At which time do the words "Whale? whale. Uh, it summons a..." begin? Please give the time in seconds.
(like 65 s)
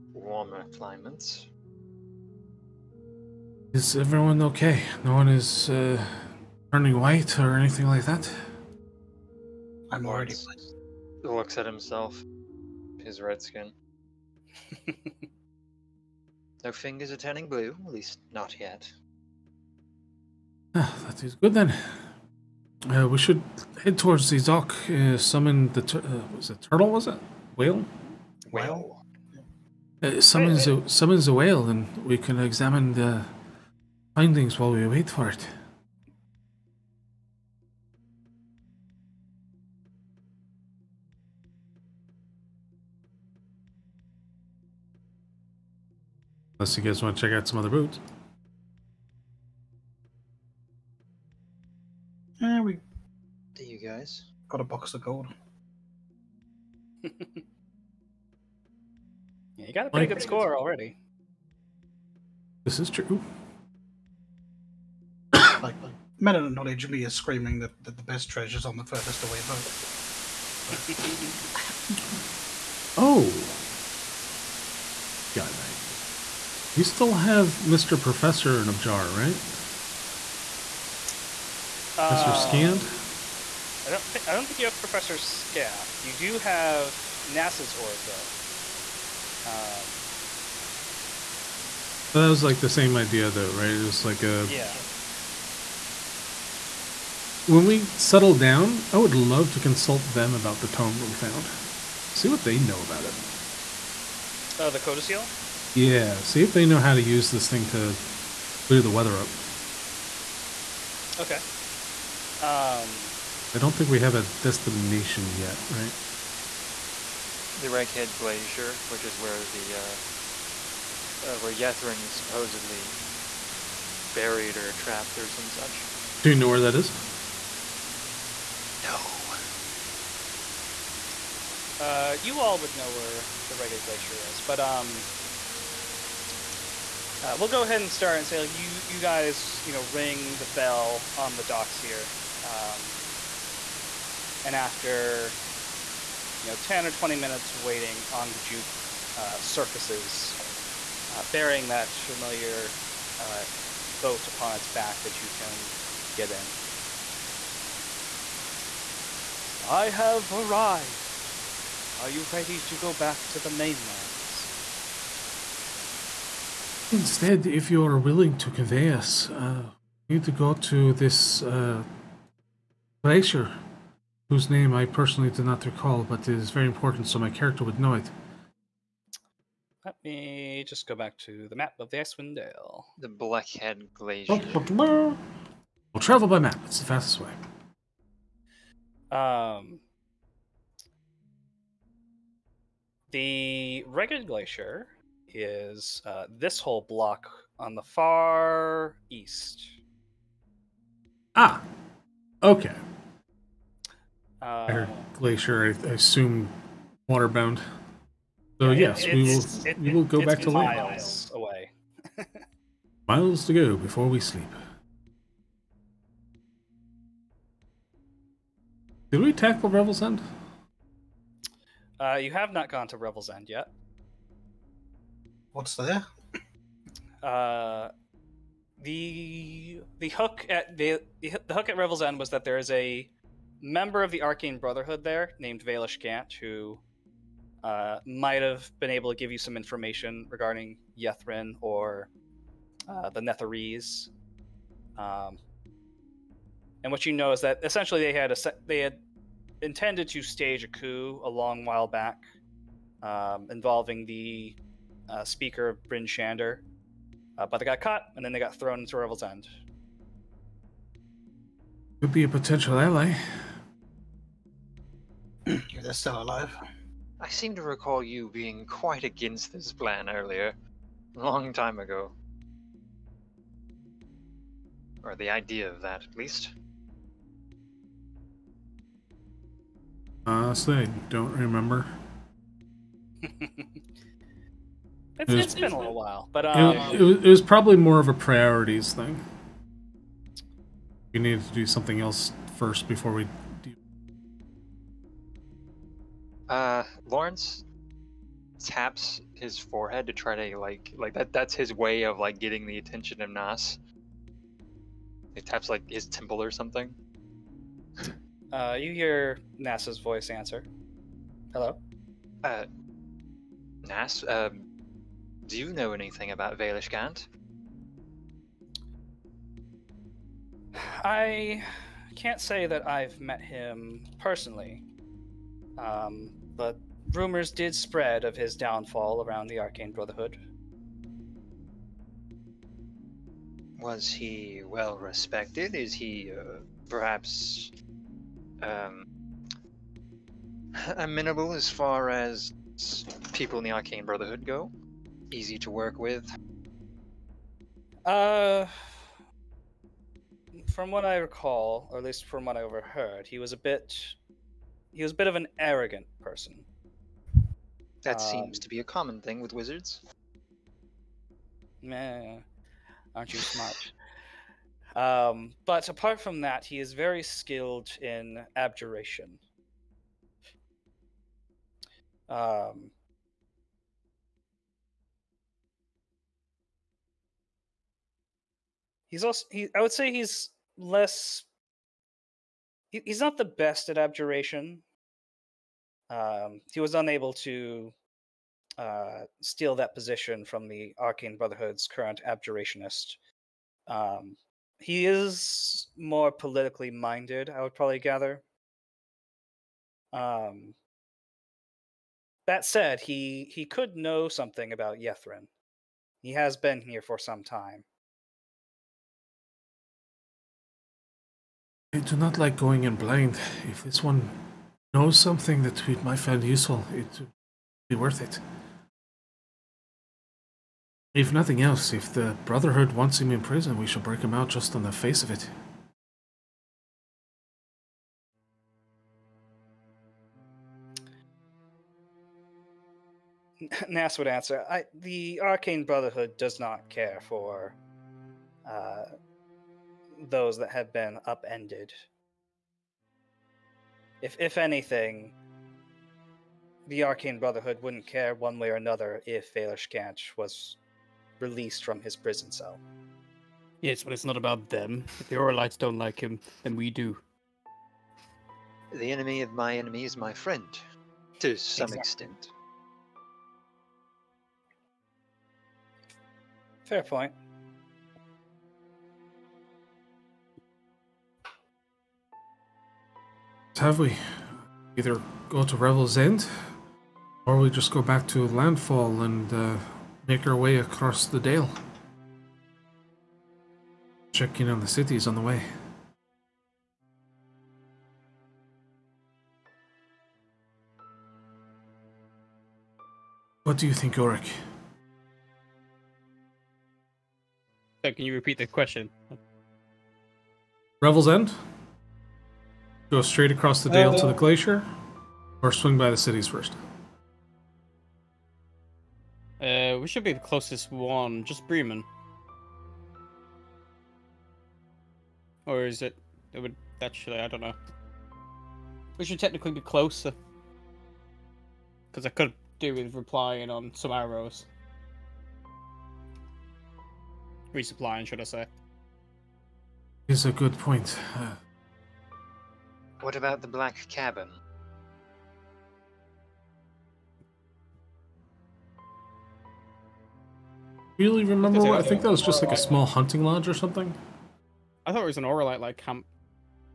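27 s.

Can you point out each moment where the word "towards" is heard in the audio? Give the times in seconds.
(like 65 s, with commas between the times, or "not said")
23 s.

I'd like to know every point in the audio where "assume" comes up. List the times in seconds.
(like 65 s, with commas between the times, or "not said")
205 s.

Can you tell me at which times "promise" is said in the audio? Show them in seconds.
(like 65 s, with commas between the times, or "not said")
not said.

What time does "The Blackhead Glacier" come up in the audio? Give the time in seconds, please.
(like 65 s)
182 s.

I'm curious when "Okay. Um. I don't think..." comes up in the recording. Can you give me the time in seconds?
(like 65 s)
111 s.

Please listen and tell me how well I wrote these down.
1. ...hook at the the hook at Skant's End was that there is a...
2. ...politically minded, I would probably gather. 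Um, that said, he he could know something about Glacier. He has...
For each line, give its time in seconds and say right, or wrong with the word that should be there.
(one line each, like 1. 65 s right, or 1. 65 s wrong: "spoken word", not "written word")
1. 230 s wrong: "Revel", not "Skant"
2. 396 s wrong: "Ythryn", not "Glacier".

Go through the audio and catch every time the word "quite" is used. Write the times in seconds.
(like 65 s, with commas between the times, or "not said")
268 s.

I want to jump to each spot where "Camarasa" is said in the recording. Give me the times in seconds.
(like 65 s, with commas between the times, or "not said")
not said.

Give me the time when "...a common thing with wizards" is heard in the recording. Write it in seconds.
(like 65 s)
358 s.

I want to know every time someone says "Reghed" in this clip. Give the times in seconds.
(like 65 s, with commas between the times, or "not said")
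117 s, 133 s, 193 s.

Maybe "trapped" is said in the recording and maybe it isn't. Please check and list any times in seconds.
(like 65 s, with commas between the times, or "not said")
124 s.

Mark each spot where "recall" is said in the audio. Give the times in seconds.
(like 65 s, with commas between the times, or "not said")
175 s, 267 s, 351 s.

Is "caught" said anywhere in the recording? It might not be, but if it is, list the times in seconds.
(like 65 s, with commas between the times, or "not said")
257 s.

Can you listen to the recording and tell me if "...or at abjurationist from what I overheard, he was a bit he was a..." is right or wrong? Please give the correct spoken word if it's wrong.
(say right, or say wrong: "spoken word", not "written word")
wrong: "least", not "abjurationist".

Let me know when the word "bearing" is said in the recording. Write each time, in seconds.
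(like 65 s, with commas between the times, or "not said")
151 s.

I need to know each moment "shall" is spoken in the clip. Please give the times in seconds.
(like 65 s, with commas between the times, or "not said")
423 s.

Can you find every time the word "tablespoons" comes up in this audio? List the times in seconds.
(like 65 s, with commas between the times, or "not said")
not said.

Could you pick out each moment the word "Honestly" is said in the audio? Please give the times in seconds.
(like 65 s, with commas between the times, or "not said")
280 s.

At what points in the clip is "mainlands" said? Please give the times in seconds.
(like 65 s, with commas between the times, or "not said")
163 s.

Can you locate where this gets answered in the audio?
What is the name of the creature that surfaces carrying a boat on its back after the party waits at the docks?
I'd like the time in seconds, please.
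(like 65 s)
148 s.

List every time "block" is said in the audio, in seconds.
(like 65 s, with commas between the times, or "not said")
196 s.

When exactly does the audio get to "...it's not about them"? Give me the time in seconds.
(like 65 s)
454 s.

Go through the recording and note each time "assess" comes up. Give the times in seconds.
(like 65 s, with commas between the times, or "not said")
not said.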